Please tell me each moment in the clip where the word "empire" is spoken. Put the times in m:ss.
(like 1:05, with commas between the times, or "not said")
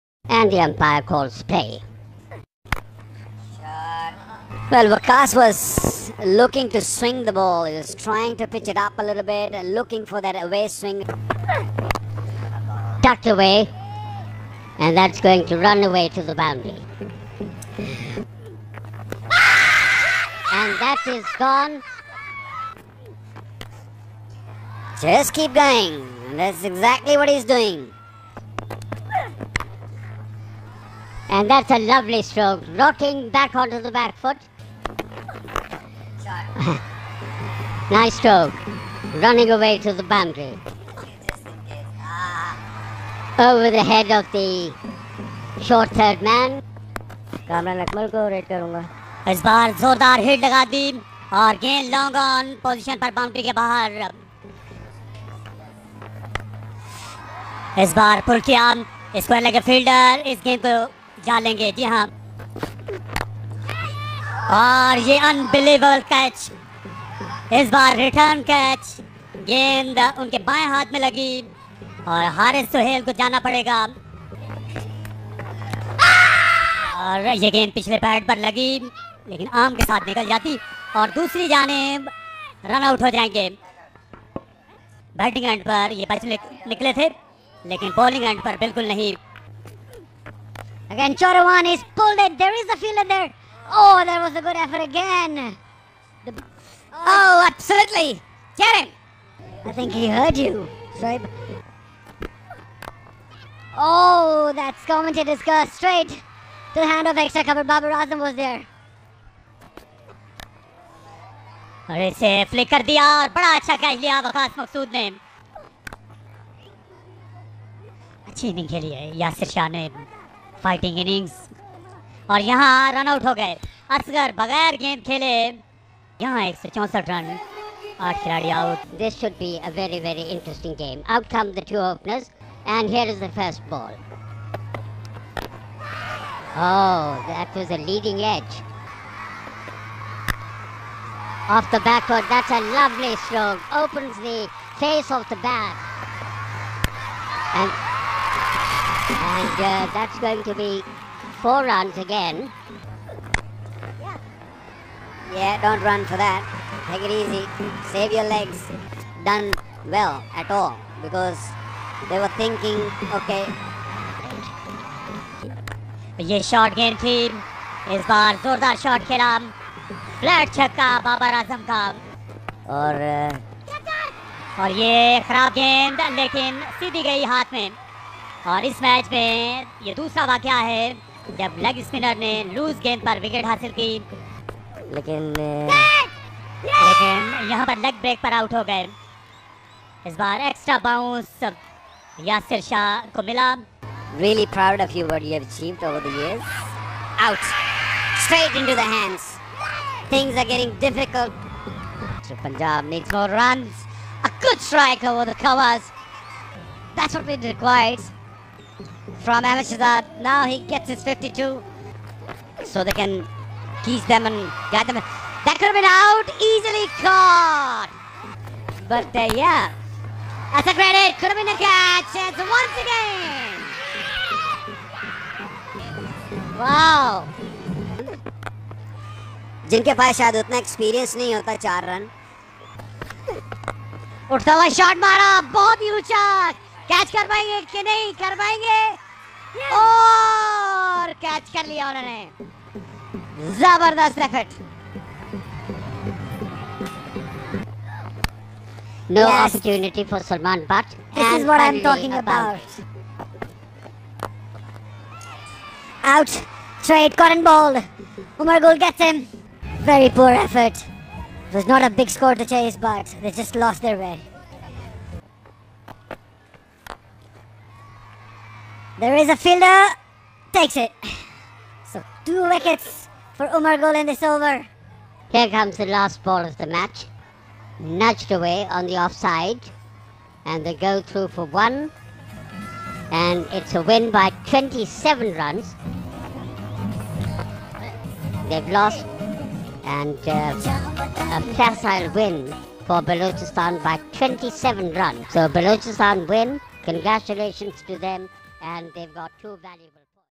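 0:00.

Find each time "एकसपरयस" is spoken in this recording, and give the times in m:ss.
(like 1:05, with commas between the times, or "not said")
3:50.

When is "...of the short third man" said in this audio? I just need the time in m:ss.
0:44.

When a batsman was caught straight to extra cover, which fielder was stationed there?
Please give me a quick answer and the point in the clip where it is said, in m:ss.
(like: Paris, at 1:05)
Babar Azam, at 1:47.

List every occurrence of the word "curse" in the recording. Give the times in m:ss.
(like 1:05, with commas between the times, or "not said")
1:45.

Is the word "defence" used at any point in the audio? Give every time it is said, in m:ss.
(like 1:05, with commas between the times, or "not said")
not said.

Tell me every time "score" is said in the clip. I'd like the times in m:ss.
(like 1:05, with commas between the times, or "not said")
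4:22.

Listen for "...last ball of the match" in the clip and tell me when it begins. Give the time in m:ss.
4:35.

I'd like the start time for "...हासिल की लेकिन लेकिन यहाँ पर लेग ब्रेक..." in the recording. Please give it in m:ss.
3:03.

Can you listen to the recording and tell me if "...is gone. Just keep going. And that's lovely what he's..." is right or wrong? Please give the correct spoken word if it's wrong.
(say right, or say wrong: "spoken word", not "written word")
wrong: "exactly", not "lovely".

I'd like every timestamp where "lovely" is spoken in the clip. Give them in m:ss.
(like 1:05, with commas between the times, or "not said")
0:31, 2:22.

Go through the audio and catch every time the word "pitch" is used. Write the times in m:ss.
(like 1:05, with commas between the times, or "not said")
0:08.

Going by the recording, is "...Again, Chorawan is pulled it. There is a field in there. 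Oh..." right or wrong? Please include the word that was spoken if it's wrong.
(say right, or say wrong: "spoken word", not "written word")
right.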